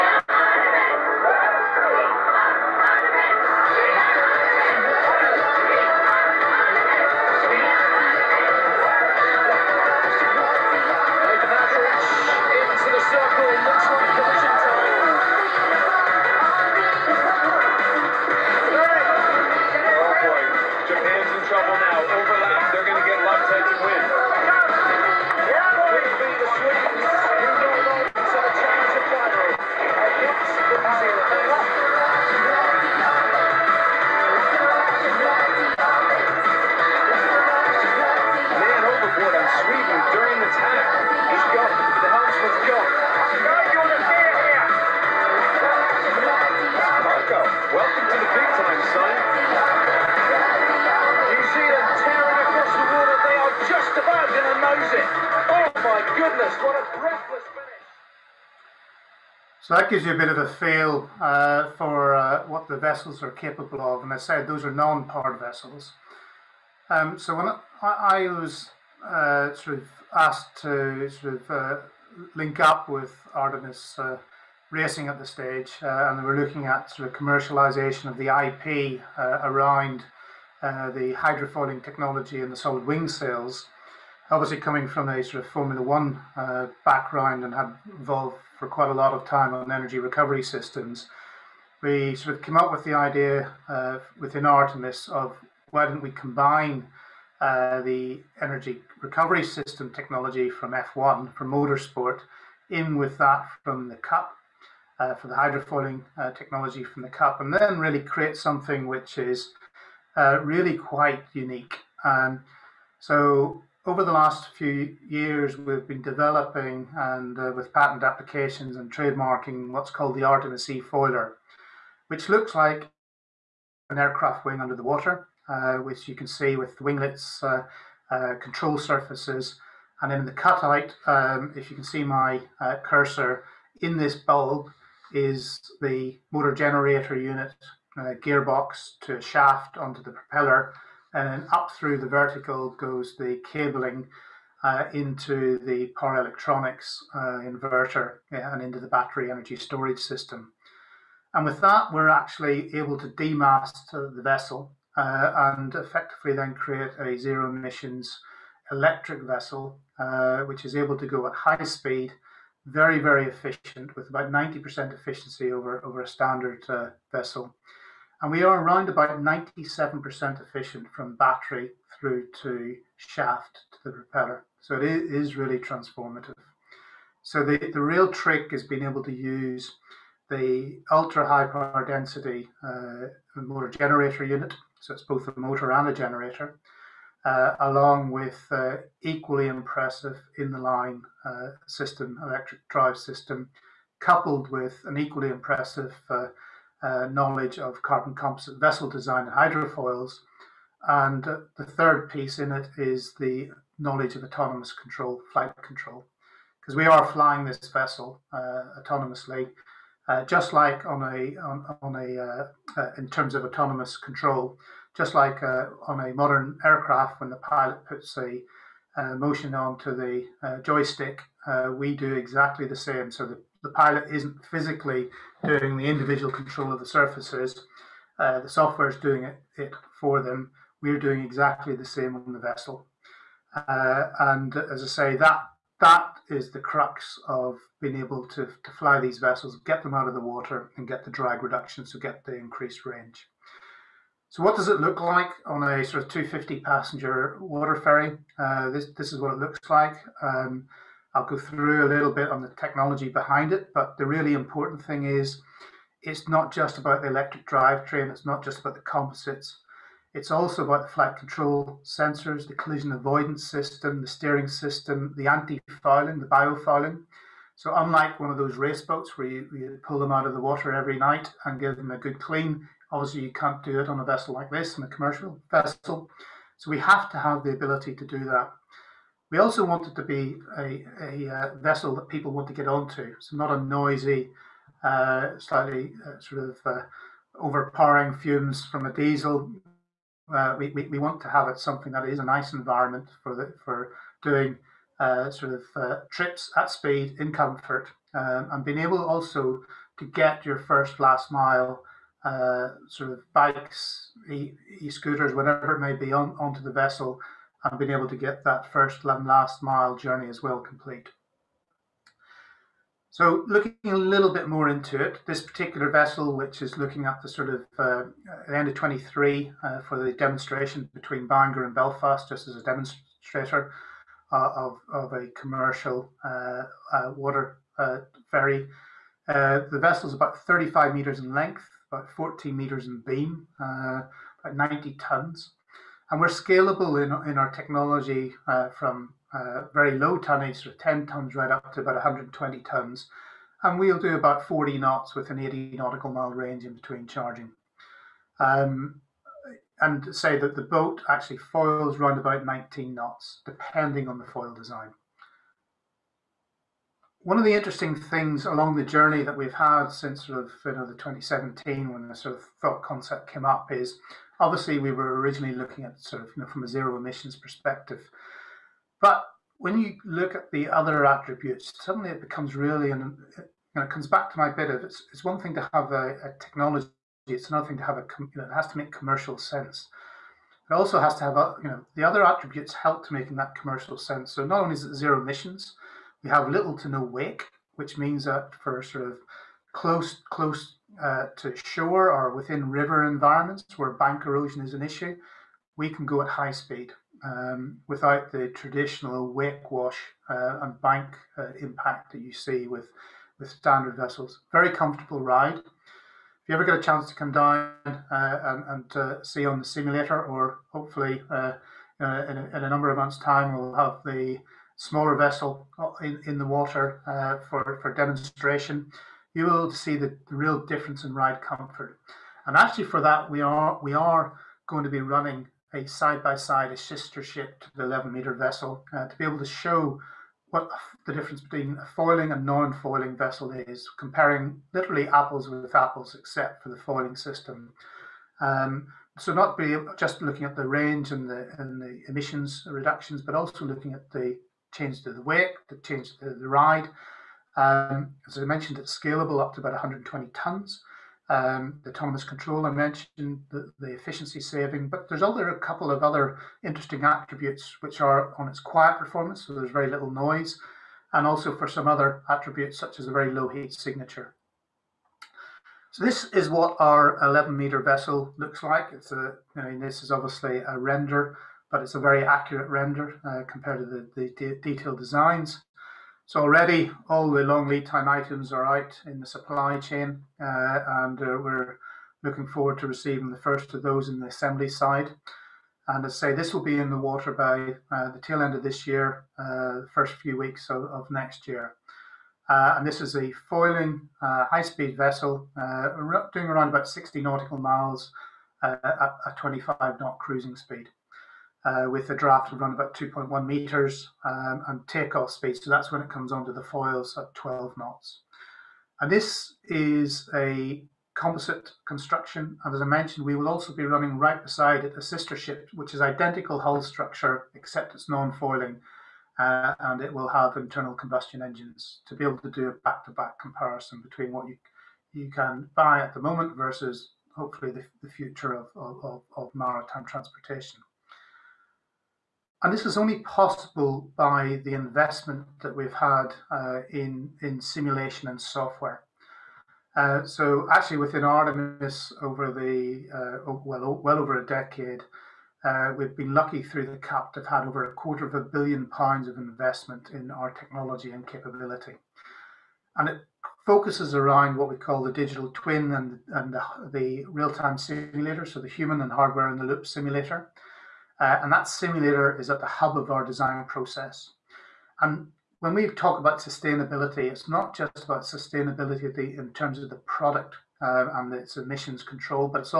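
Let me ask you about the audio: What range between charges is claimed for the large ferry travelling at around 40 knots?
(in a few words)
80 nautical miles.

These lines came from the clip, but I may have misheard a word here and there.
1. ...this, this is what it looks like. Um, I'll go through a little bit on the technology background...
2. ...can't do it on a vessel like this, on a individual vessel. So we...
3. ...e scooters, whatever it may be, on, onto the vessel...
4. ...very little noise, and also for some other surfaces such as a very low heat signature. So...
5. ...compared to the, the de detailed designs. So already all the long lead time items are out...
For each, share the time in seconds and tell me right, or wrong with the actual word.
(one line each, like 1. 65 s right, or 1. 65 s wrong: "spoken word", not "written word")
1. 248 s wrong: "behind", not "background"
2. 273 s wrong: "commercial", not "individual"
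3. 304 s right
4. 459 s wrong: "attributes", not "surfaces"
5. 473 s right.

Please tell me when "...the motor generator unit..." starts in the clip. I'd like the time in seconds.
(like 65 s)
135 s.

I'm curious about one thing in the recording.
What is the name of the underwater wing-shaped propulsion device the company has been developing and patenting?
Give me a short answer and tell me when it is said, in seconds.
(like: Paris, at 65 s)
Artemis E foiler, at 120 s.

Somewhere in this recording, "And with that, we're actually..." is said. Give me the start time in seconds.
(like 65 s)
151 s.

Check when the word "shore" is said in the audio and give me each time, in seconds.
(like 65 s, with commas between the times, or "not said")
391 s.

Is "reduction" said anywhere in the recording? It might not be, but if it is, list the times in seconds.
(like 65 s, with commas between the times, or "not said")
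241 s, 442 s.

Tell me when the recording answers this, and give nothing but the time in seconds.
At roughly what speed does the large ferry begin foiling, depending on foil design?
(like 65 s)
352 s.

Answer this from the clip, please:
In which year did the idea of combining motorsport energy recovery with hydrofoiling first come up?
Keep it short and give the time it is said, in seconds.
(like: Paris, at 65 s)
2017, at 360 s.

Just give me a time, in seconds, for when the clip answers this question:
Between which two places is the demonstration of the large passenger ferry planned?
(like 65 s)
321 s.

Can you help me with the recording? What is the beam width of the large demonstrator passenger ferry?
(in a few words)
14 meters.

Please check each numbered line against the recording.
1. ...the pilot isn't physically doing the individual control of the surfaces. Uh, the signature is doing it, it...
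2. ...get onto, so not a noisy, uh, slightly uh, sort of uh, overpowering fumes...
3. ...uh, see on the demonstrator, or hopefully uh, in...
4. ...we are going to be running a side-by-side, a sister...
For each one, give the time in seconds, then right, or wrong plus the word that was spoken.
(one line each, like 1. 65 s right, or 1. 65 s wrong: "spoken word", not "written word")
1. 223 s wrong: "software", not "signature"
2. 282 s right
3. 408 s wrong: "simulator", not "demonstrator"
4. 423 s right.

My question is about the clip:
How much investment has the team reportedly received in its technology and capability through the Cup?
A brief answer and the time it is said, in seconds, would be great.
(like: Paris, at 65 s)
over a quarter of a billion pounds, at 547 s.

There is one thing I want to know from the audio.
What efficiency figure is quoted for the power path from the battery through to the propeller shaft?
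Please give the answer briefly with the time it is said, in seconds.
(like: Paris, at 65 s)
97%, at 169 s.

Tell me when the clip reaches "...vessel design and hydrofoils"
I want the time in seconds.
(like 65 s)
198 s.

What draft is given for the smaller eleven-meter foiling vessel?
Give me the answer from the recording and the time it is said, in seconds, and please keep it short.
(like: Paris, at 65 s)
2.1 meters, at 502 s.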